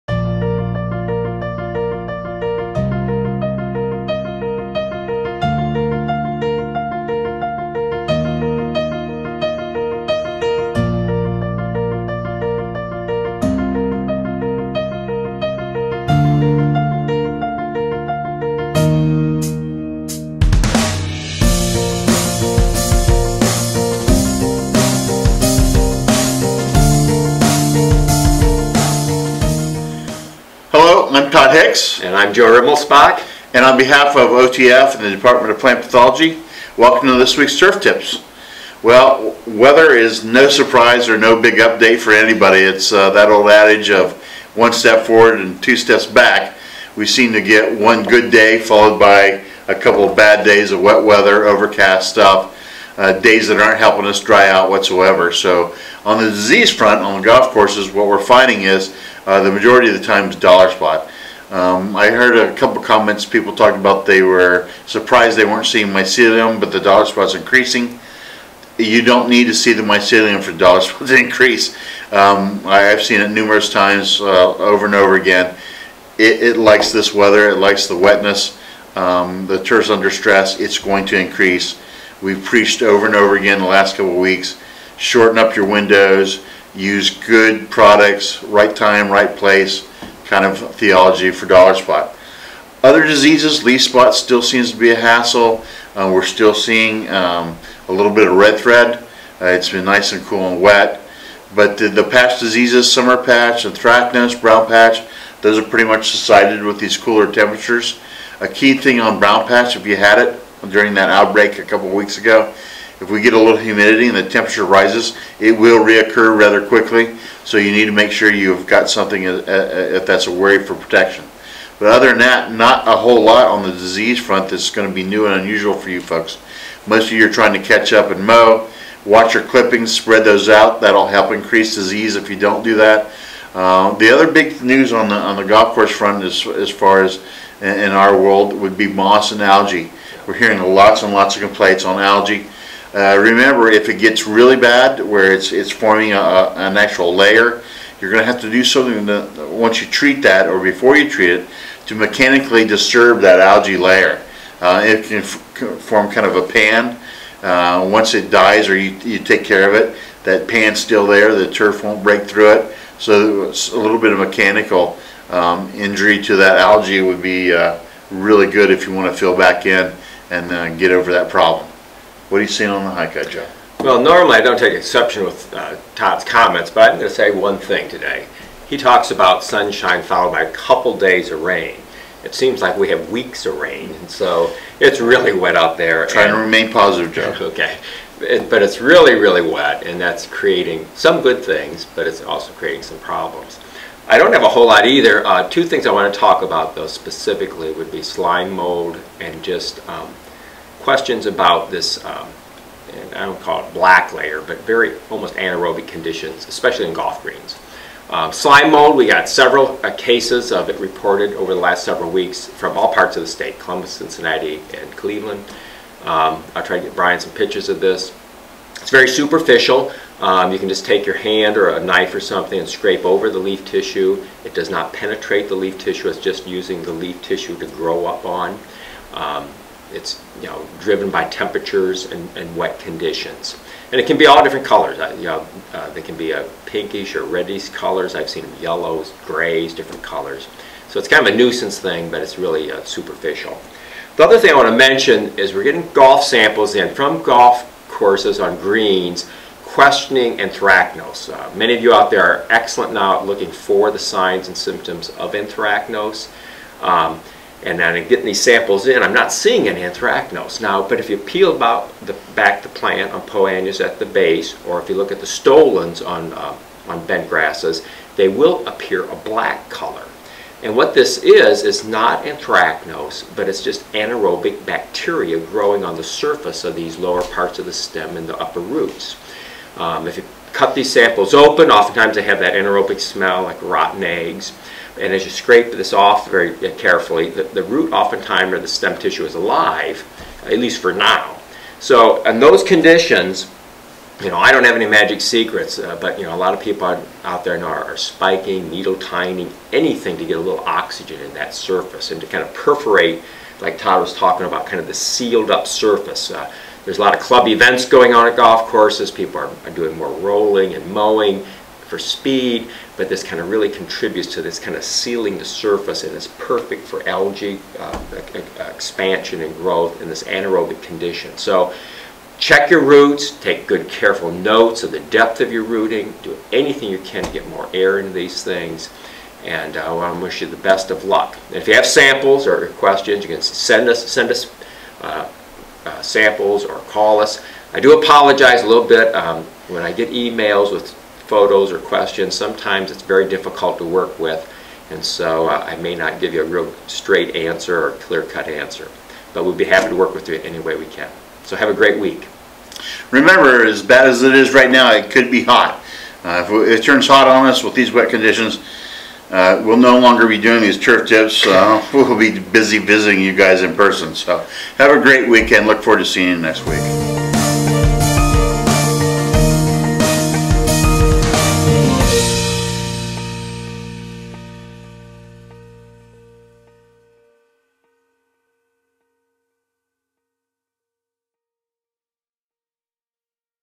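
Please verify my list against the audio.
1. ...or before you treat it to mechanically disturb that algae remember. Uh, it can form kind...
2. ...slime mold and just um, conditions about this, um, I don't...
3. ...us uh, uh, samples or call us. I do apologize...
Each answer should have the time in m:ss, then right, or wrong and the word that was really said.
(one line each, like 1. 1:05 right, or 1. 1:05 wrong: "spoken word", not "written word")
1. 2:30 wrong: "layer", not "remember"
2. 3:18 wrong: "questions", not "conditions"
3. 5:34 right.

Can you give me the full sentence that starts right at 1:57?
So you need to make sure you've got something uh, uh, uh, if that's a worry for protection.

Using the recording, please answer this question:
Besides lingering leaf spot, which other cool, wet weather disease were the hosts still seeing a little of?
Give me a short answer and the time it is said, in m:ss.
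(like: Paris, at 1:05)
red thread, at 1:38.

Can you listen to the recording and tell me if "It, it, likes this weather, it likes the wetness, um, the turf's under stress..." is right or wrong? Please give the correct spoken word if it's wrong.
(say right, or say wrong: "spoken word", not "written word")
right.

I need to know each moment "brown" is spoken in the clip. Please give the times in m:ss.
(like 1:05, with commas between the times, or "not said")
1:44, 1:49.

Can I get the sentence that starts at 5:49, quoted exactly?
But we'll be happy to work with you any way we can.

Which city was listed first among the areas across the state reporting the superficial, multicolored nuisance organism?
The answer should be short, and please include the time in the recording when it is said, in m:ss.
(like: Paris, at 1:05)
Columbus, at 3:33.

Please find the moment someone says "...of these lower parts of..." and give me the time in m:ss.
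4:36.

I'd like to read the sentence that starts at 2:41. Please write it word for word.
The turf won't break through it.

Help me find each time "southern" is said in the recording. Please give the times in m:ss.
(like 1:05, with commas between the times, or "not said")
not said.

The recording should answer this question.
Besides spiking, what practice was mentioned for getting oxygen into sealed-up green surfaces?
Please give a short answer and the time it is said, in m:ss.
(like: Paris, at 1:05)
needle tining, at 4:58.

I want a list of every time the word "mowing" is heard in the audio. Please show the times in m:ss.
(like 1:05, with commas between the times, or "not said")
5:10.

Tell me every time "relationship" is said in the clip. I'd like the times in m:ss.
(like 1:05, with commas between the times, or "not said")
not said.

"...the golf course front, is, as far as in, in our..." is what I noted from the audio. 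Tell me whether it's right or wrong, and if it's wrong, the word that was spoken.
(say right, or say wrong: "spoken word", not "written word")
right.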